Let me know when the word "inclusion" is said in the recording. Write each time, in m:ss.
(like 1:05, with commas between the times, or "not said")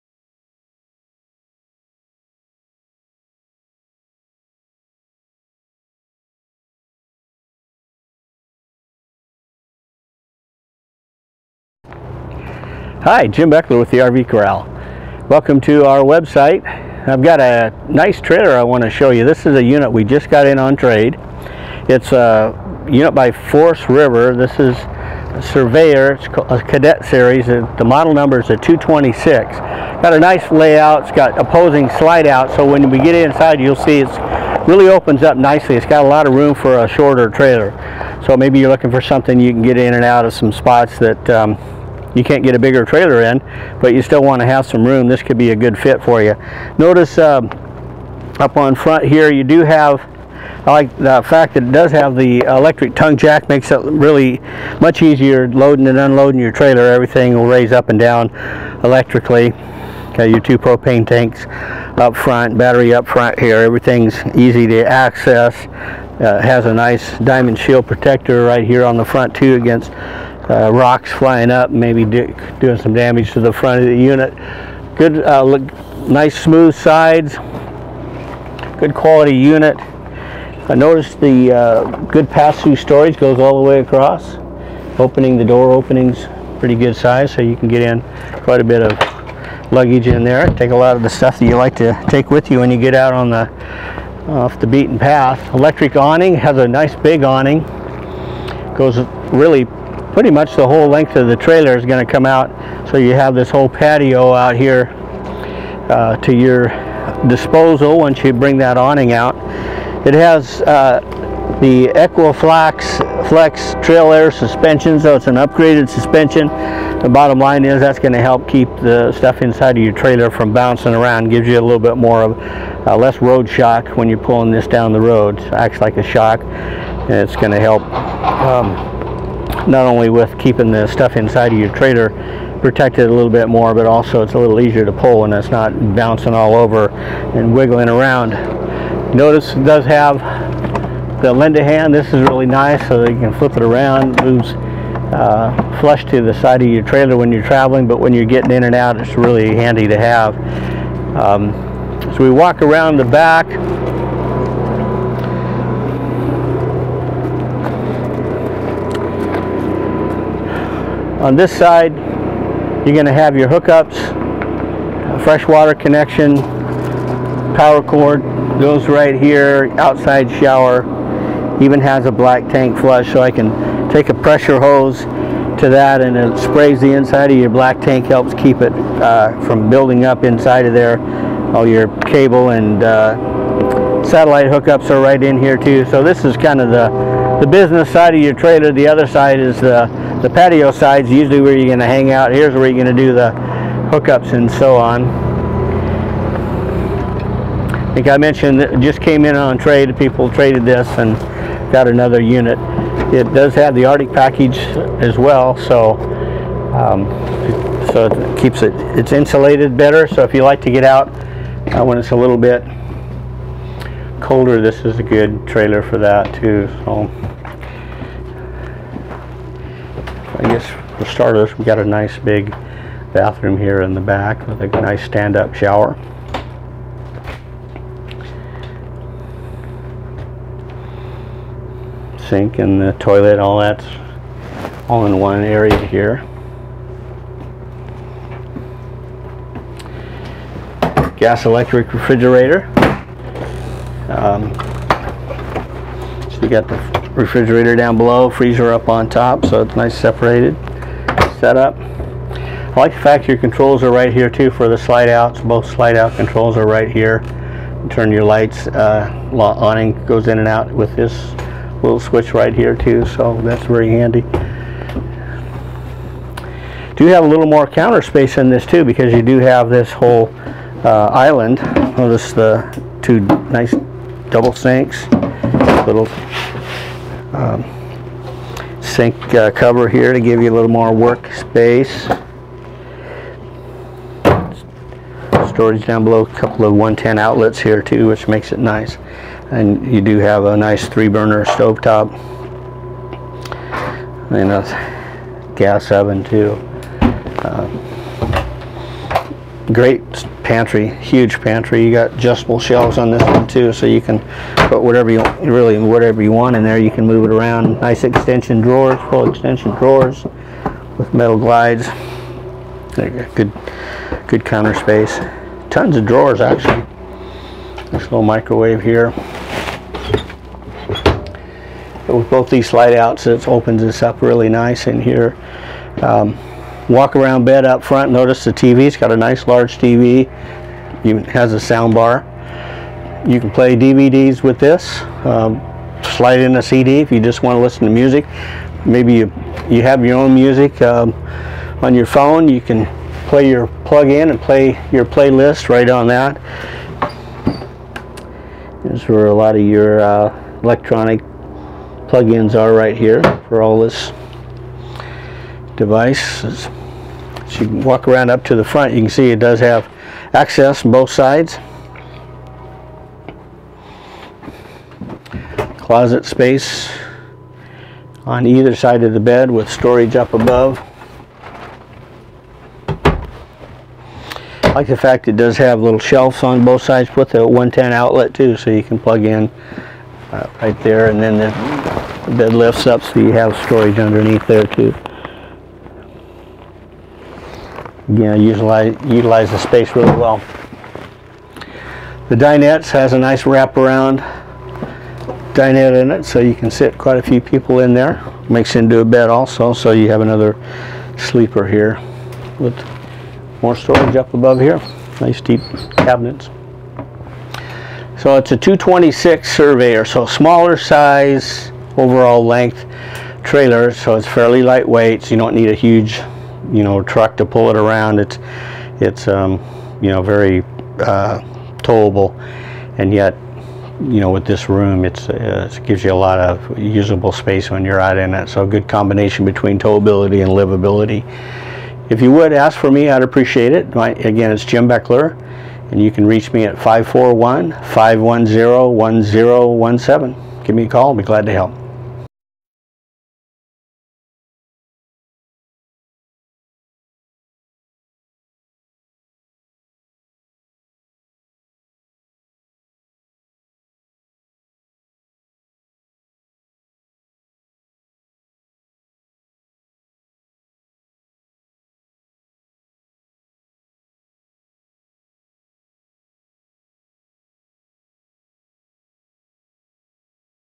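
not said.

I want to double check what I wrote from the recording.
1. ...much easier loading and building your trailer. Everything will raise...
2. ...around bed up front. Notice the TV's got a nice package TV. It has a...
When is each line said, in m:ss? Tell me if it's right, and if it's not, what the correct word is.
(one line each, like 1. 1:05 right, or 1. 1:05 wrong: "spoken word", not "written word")
1. 0:54 wrong: "unloading", not "building"
2. 5:27 wrong: "large", not "package".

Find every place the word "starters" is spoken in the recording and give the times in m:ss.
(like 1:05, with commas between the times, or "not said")
3:41.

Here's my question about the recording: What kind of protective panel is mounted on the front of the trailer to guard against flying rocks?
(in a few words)
Diamond shield.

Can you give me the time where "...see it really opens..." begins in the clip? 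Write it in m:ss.
0:33.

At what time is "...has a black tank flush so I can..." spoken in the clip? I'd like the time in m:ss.
2:51.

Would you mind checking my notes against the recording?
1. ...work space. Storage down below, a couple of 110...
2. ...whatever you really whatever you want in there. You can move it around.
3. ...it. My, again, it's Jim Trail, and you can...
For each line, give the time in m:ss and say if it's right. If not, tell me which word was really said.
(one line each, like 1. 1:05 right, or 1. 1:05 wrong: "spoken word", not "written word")
1. 4:40 right
2. 5:04 right
3. 7:13 wrong: "Beckler", not "Trail".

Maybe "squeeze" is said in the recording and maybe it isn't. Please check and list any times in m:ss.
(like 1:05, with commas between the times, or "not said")
not said.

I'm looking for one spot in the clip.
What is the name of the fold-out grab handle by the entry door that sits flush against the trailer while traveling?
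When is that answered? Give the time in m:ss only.
2:21.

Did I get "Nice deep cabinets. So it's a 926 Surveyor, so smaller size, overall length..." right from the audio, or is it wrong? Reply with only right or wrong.
wrong.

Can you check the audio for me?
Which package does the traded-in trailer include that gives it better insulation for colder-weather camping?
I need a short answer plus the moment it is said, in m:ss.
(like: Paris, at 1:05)
Arctic package, at 3:23.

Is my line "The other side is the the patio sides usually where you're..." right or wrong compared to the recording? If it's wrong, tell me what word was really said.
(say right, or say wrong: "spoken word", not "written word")
right.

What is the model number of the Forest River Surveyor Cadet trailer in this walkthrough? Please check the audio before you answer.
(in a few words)
226.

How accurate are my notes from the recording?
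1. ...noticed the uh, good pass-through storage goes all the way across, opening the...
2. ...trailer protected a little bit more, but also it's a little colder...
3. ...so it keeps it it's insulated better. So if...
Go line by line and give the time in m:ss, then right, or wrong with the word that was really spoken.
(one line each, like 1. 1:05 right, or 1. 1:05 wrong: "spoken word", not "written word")
1. 1:20 right
2. 2:11 wrong: "easier", not "colder"
3. 3:27 right.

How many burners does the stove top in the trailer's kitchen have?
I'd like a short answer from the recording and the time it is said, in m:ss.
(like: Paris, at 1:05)
3, at 4:50.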